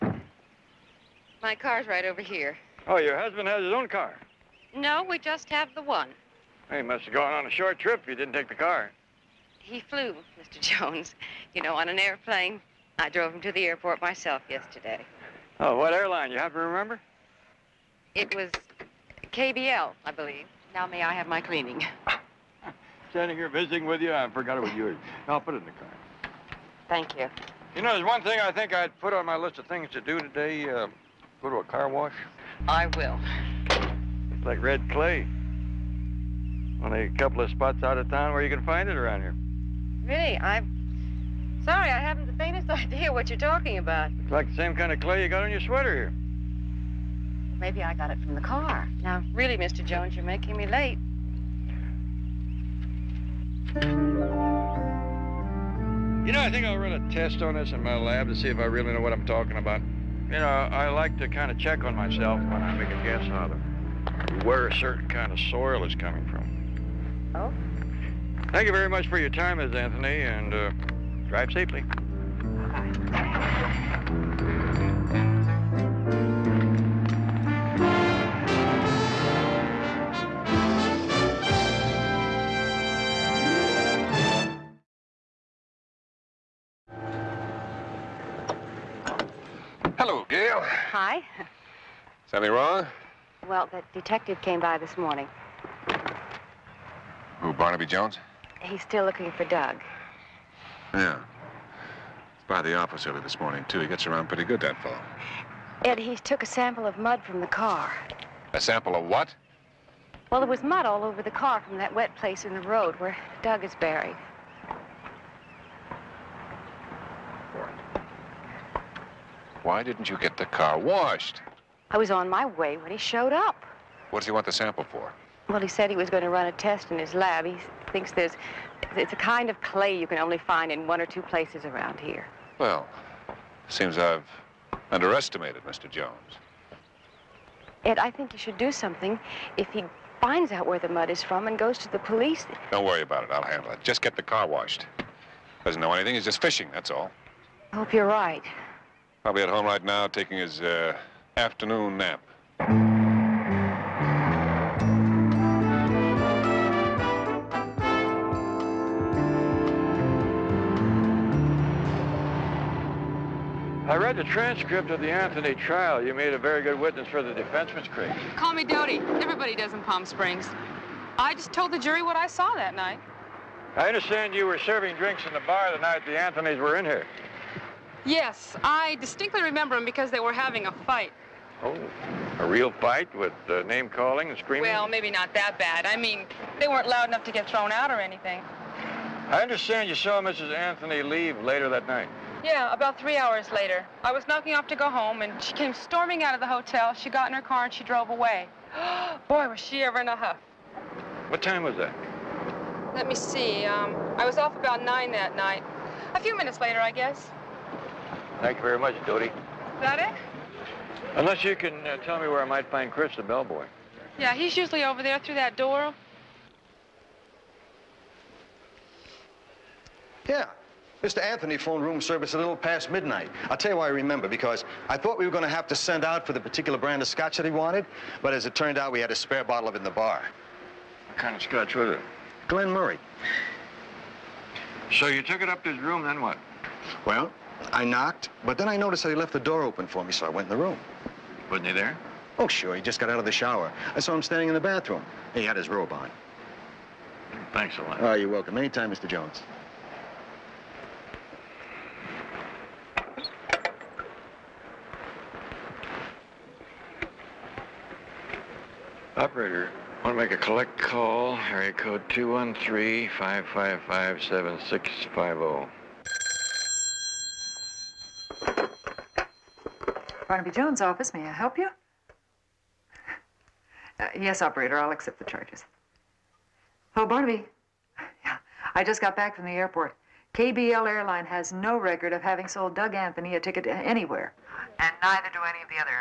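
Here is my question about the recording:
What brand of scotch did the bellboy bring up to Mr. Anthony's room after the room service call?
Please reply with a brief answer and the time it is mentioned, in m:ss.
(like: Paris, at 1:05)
Glen Murray, at 3:52.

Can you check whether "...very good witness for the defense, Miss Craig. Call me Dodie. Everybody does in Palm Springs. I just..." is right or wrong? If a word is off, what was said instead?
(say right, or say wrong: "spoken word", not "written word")
right.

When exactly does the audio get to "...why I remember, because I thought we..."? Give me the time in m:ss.
3:43.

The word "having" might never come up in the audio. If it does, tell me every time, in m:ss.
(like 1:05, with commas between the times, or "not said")
3:00, 4:42.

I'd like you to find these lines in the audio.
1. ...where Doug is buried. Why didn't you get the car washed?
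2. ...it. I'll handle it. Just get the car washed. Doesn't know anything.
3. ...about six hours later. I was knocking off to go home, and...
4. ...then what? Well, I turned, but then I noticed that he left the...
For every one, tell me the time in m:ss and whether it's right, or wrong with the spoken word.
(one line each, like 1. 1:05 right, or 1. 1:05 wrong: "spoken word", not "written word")
1. 1:52 right
2. 2:23 right
3. 3:12 wrong: "three", not "six"
4. 3:56 wrong: "knocked", not "turned".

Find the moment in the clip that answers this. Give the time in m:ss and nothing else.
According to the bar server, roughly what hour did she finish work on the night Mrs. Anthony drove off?
3:24.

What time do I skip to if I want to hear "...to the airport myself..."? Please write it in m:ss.
0:13.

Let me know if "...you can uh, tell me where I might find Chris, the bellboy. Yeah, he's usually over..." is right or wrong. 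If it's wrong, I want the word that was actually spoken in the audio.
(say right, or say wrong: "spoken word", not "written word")
right.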